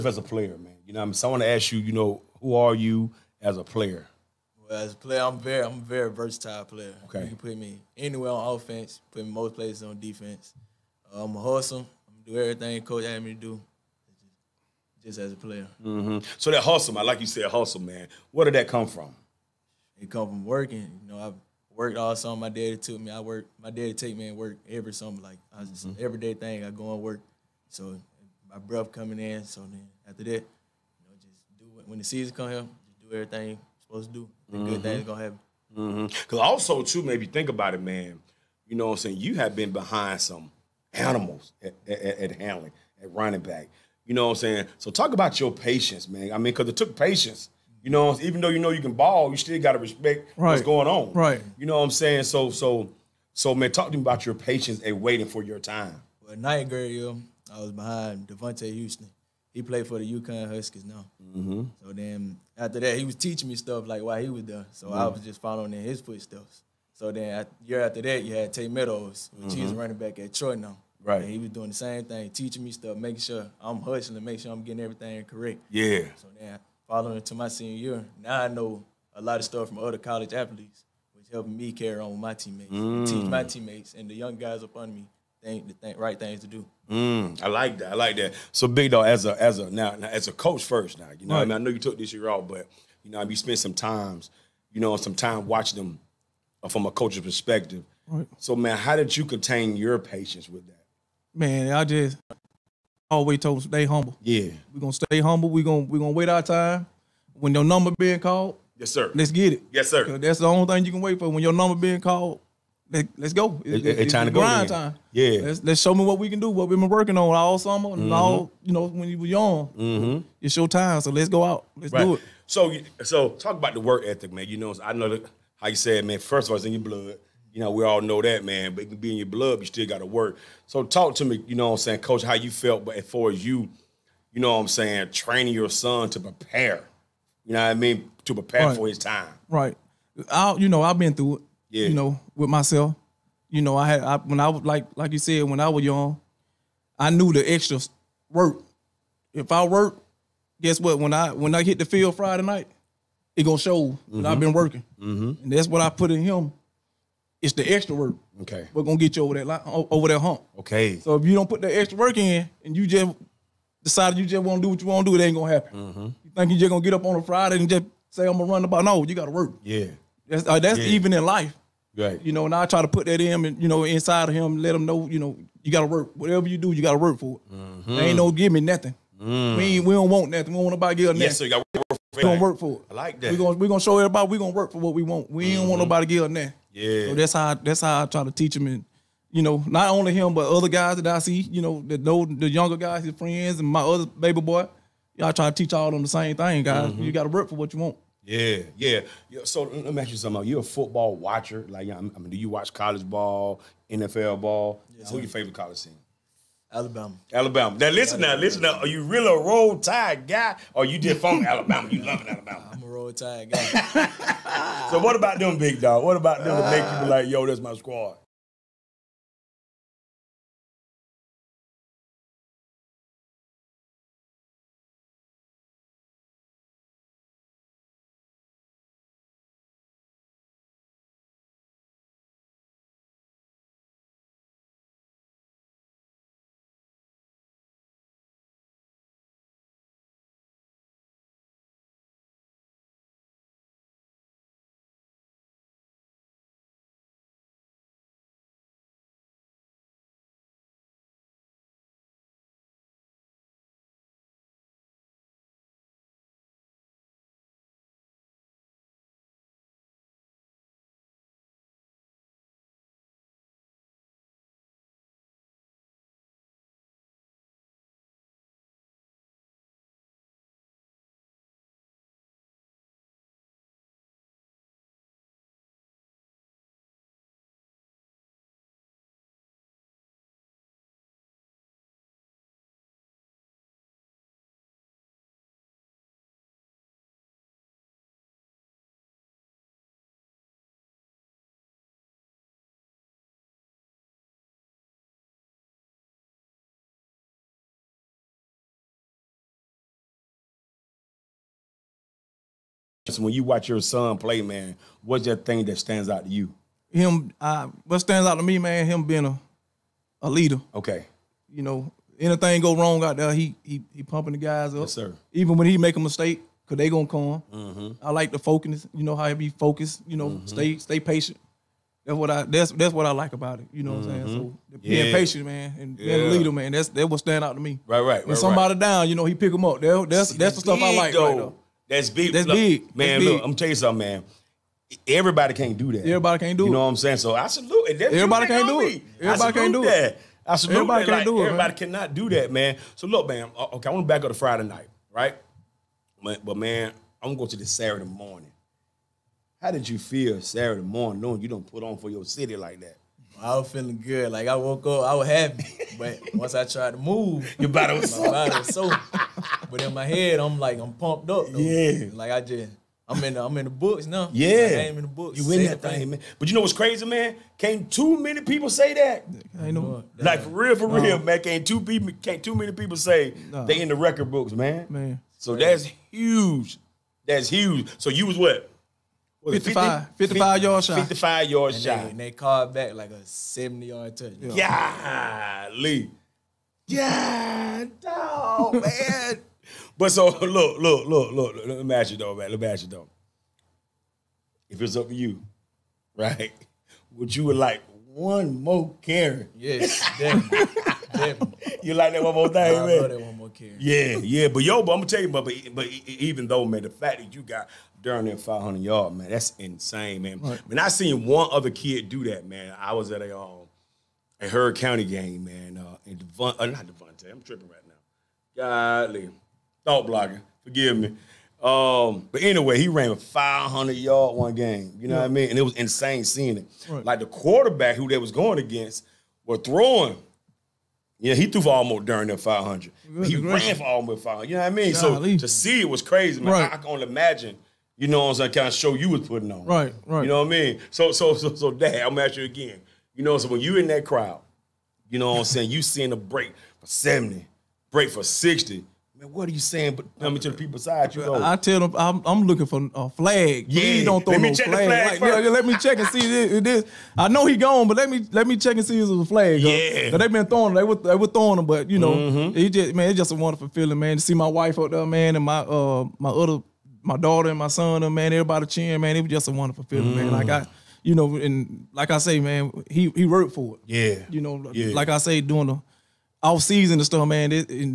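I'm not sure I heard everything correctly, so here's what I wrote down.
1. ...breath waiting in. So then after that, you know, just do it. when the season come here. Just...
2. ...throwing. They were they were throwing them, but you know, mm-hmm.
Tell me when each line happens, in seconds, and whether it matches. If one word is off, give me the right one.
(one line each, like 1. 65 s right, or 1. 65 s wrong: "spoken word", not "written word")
1. 28 s wrong: "coming", not "waiting"
2. 460 s right.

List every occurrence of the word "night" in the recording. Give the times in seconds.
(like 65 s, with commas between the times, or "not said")
56 s, 152 s, 344 s.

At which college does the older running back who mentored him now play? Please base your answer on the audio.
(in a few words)
Troy.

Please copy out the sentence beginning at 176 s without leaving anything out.
Whatever you do, you gotta work for it.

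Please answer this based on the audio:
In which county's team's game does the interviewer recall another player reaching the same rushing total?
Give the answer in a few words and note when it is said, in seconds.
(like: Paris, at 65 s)
Heard County, at 414 s.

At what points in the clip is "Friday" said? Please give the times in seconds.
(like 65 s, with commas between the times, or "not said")
152 s, 167 s, 344 s.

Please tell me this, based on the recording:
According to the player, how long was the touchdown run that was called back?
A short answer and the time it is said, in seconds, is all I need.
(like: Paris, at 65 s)
70 yards, at 383 s.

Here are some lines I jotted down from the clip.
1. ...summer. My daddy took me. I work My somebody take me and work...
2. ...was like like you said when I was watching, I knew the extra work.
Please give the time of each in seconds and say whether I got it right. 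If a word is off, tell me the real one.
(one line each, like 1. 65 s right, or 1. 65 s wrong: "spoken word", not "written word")
1. 22 s wrong: "daddy", not "somebody"
2. 144 s wrong: "young", not "watching".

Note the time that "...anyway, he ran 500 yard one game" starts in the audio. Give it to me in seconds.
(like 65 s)
422 s.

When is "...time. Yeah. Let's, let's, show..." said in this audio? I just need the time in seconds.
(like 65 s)
114 s.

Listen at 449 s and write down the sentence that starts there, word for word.
But tell me to the people beside you, though.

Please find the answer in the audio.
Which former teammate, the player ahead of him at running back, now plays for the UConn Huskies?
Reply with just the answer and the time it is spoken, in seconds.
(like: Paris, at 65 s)
Devontae Houston, at 58 s.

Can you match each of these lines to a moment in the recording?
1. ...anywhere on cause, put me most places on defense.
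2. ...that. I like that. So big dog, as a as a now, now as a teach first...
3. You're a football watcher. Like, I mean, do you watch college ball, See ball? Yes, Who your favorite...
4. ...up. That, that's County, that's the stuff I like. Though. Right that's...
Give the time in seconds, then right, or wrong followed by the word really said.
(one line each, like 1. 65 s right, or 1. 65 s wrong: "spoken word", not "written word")
1. 7 s wrong: "offense", not "cause"
2. 87 s wrong: "coach", not "teach"
3. 200 s wrong: "NFL", not "See"
4. 329 s wrong: "See", not "County".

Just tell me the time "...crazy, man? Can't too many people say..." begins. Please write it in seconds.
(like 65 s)
366 s.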